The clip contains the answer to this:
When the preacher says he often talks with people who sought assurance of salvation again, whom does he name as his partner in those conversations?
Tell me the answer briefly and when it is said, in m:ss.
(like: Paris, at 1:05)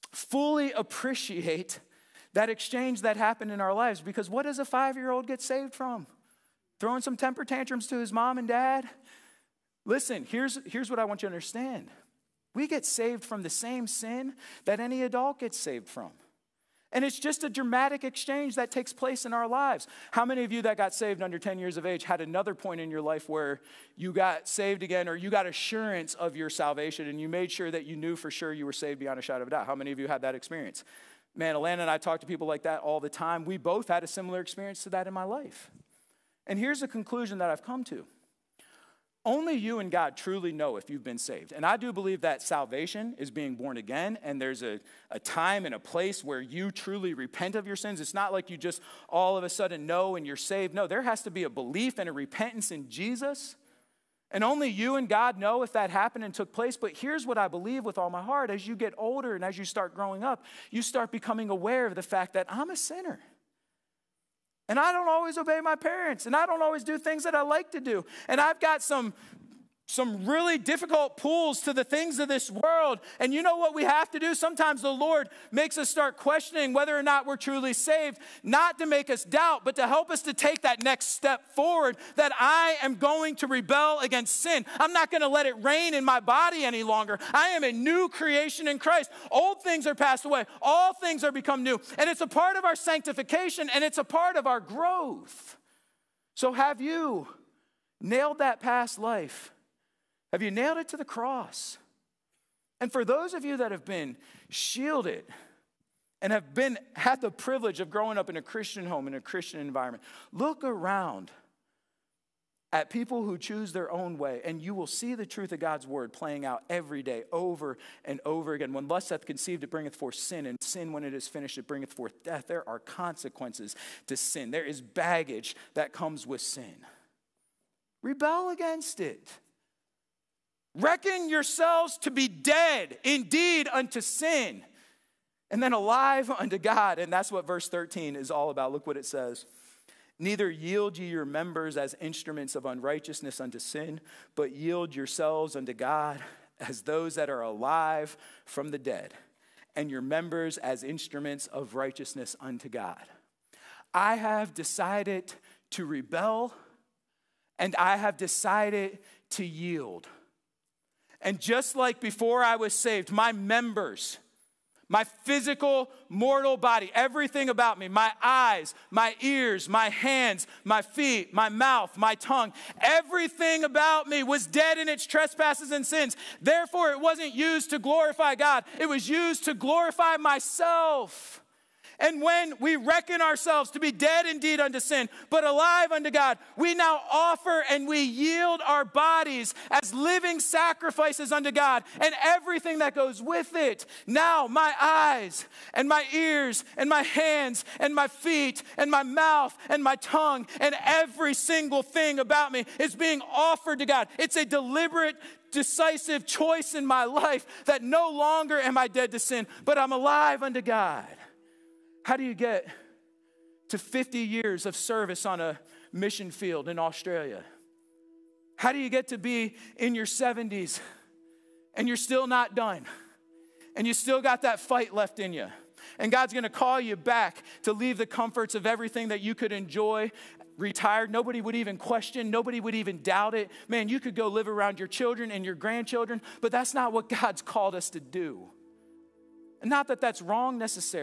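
Alana, at 0:31.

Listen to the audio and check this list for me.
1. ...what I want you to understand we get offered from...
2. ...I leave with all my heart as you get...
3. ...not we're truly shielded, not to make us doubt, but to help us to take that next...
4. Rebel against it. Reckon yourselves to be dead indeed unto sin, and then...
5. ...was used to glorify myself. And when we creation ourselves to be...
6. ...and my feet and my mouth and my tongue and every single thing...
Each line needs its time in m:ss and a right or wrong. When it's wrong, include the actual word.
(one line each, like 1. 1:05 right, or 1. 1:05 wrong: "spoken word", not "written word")
1. 0:10 wrong: "saved", not "offered"
2. 0:57 wrong: "believe", not "leave"
3. 1:17 wrong: "saved", not "shielded"
4. 2:08 right
5. 2:58 wrong: "reckon", not "creation"
6. 3:17 right.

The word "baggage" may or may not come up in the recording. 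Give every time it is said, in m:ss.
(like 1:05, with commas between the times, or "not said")
2:04.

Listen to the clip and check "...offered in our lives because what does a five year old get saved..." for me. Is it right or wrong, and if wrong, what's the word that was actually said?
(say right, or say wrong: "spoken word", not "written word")
wrong: "happened", not "offered".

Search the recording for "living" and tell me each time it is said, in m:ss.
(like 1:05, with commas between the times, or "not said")
3:09.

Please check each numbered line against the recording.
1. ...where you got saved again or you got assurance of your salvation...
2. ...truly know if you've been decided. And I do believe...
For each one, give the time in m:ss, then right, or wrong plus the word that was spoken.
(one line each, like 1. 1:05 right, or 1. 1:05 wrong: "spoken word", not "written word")
1. 0:23 right
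2. 0:40 wrong: "saved", not "decided".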